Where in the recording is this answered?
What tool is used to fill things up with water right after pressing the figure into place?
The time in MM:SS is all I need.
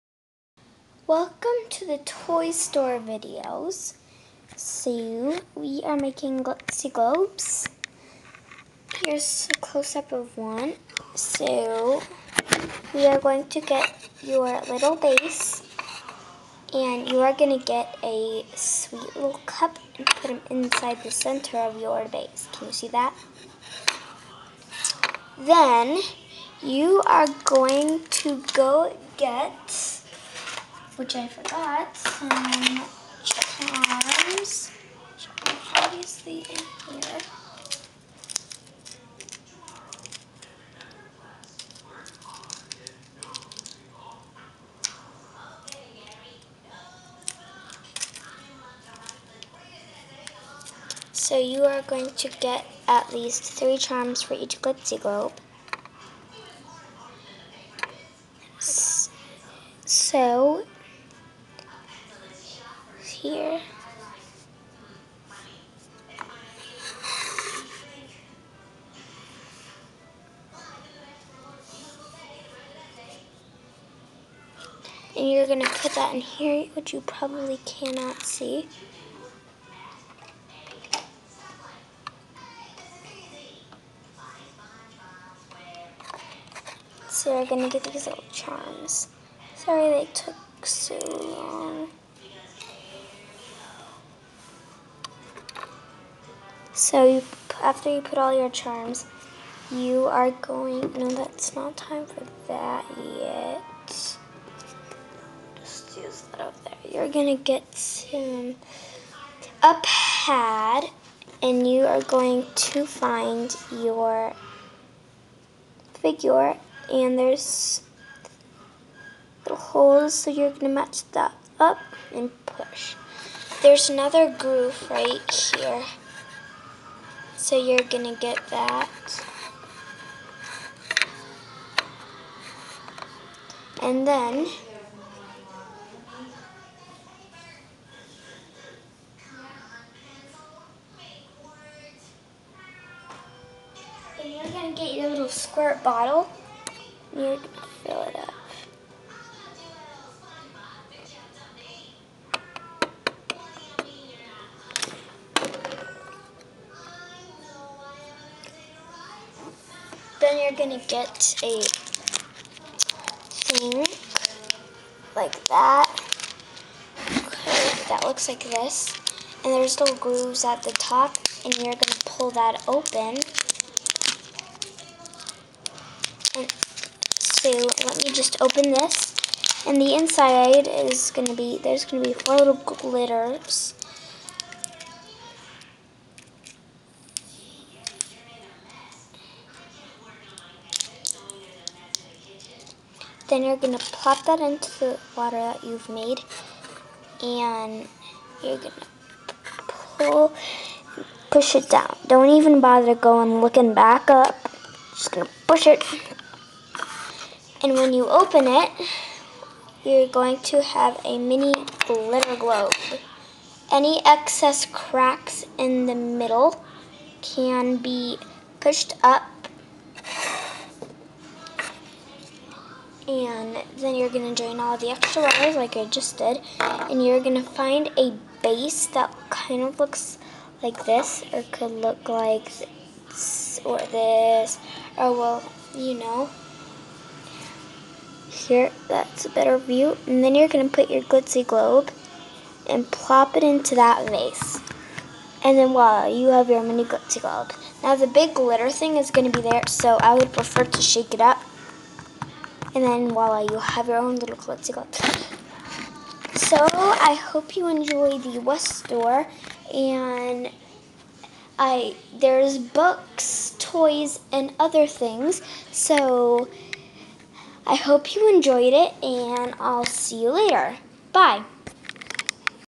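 02:25.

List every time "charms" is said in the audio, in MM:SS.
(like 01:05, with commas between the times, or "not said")
00:33, 00:53, 01:28, 01:38.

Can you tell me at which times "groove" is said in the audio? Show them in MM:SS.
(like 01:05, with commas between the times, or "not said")
02:04, 02:49.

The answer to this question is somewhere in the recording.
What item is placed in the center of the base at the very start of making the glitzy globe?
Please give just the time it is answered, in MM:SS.
00:18.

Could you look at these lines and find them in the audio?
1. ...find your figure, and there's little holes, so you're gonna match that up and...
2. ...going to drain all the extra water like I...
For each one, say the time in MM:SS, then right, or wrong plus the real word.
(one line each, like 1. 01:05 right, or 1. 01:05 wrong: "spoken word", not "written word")
1. 01:52 right
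2. 03:44 right.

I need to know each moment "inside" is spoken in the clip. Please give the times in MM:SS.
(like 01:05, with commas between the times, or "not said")
00:20, 02:59.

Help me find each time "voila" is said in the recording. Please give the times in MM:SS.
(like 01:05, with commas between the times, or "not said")
04:05, 04:13.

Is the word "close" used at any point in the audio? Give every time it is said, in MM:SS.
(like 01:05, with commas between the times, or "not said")
00:09.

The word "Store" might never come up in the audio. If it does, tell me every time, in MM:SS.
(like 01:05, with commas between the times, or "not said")
00:02, 04:18.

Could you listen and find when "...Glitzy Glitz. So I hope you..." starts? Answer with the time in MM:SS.
04:14.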